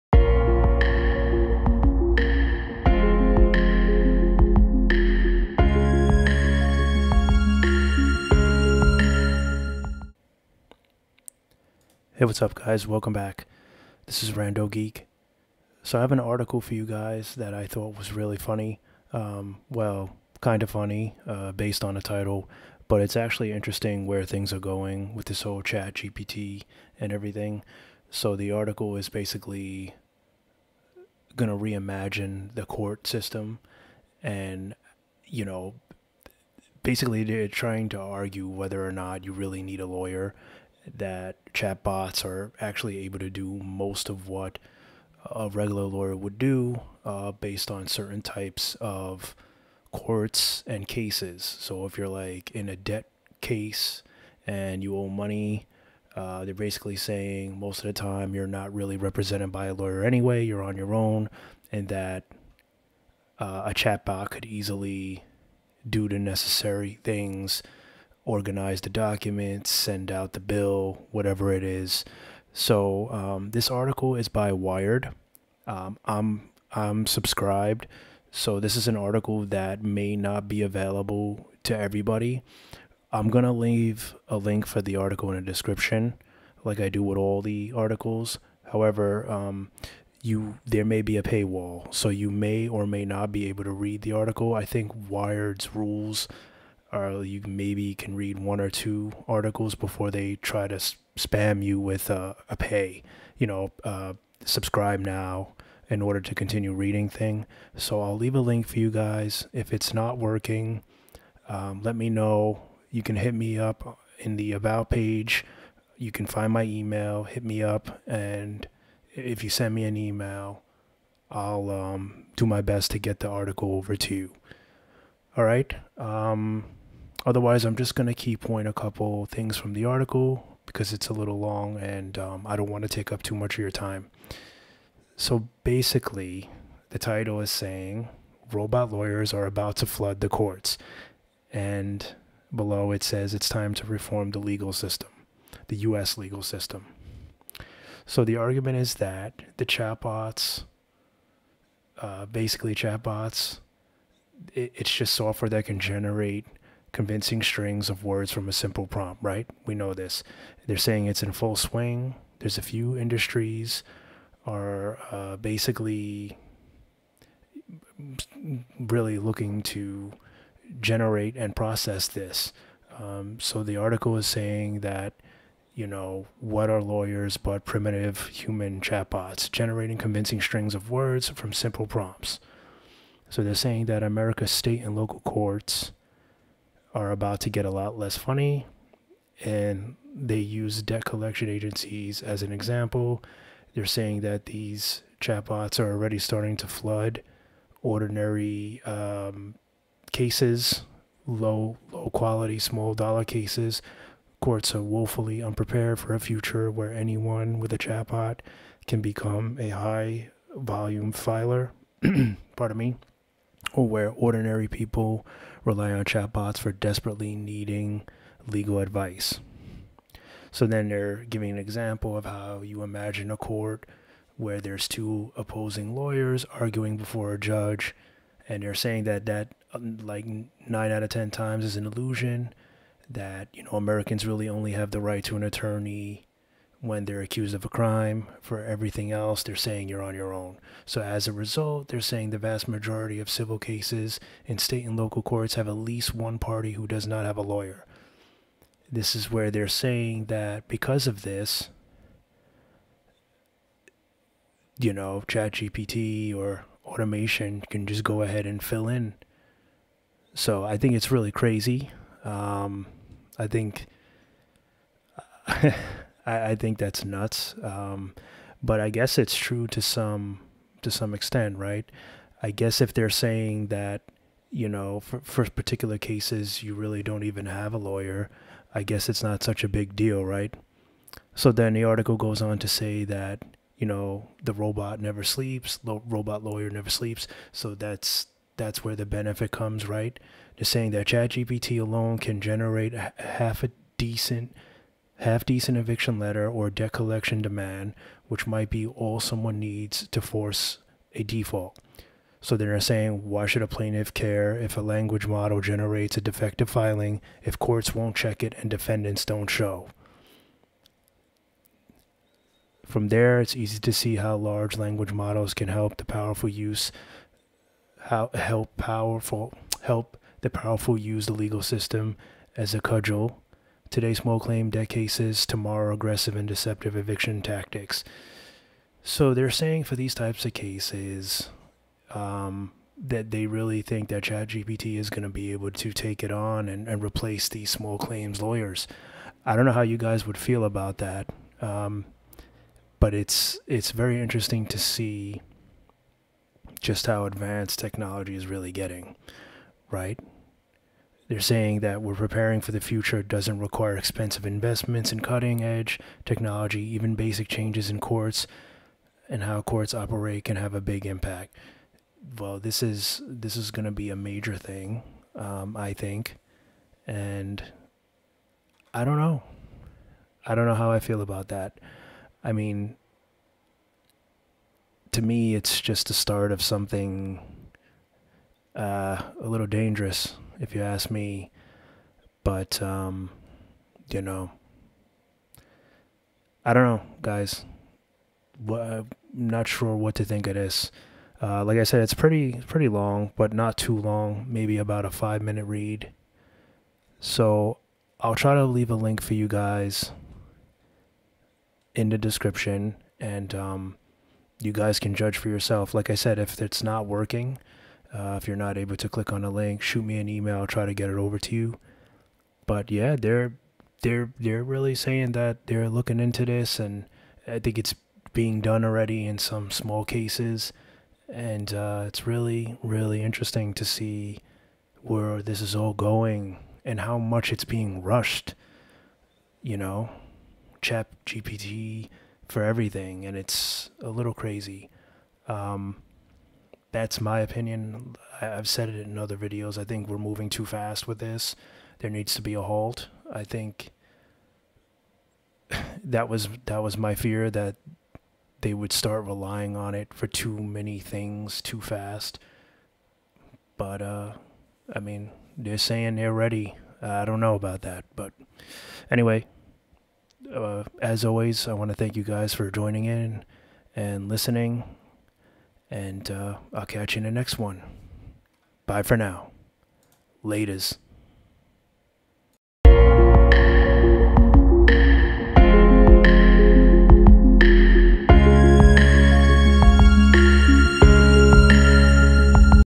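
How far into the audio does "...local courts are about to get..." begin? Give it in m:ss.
3:04.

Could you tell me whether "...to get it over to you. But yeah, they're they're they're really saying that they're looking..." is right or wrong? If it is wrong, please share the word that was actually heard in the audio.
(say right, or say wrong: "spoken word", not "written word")
right.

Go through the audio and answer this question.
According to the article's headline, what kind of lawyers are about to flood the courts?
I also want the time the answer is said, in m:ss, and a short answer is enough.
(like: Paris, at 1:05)
robot lawyers, at 2:18.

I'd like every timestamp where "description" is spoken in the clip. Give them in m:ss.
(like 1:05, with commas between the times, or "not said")
1:25, 6:42.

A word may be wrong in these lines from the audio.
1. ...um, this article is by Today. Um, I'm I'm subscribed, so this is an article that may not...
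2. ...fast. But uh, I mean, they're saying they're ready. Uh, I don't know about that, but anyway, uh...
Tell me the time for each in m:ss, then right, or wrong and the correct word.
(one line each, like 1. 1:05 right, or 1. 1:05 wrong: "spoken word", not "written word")
1. 1:13 wrong: "Wired", not "Today"
2. 7:31 right.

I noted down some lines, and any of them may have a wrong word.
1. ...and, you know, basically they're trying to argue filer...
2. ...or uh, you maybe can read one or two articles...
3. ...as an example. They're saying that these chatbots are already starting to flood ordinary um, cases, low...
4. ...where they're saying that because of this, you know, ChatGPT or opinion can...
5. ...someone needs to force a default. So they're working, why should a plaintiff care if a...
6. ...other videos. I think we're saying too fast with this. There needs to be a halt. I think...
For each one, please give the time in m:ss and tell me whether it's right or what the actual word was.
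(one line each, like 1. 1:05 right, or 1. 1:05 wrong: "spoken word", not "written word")
1. 0:34 wrong: "whether", not "filer"
2. 1:36 right
3. 3:12 right
4. 4:09 wrong: "automation", not "opinion"
5. 4:59 wrong: "saying", not "working"
6. 7:19 wrong: "moving", not "saying".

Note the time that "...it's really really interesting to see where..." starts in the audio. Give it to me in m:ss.
7:02.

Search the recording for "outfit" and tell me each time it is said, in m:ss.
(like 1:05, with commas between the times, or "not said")
not said.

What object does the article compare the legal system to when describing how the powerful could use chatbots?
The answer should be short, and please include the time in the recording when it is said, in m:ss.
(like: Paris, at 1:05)
a cudgel, at 5:22.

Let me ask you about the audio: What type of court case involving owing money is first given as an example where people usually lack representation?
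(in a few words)
debt case.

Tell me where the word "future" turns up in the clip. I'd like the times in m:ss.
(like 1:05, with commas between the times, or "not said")
3:26, 5:52.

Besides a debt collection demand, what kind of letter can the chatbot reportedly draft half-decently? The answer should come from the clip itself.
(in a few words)
eviction letter.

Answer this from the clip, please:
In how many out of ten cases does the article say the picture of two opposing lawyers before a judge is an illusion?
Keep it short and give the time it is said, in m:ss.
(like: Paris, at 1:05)
9 out of 10, at 3:50.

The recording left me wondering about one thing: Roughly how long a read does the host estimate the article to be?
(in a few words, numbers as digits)
5 minutes.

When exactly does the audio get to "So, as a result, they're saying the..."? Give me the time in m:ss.
4:00.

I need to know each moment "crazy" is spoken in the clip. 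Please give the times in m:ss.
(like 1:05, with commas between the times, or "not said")
4:21, 7:14.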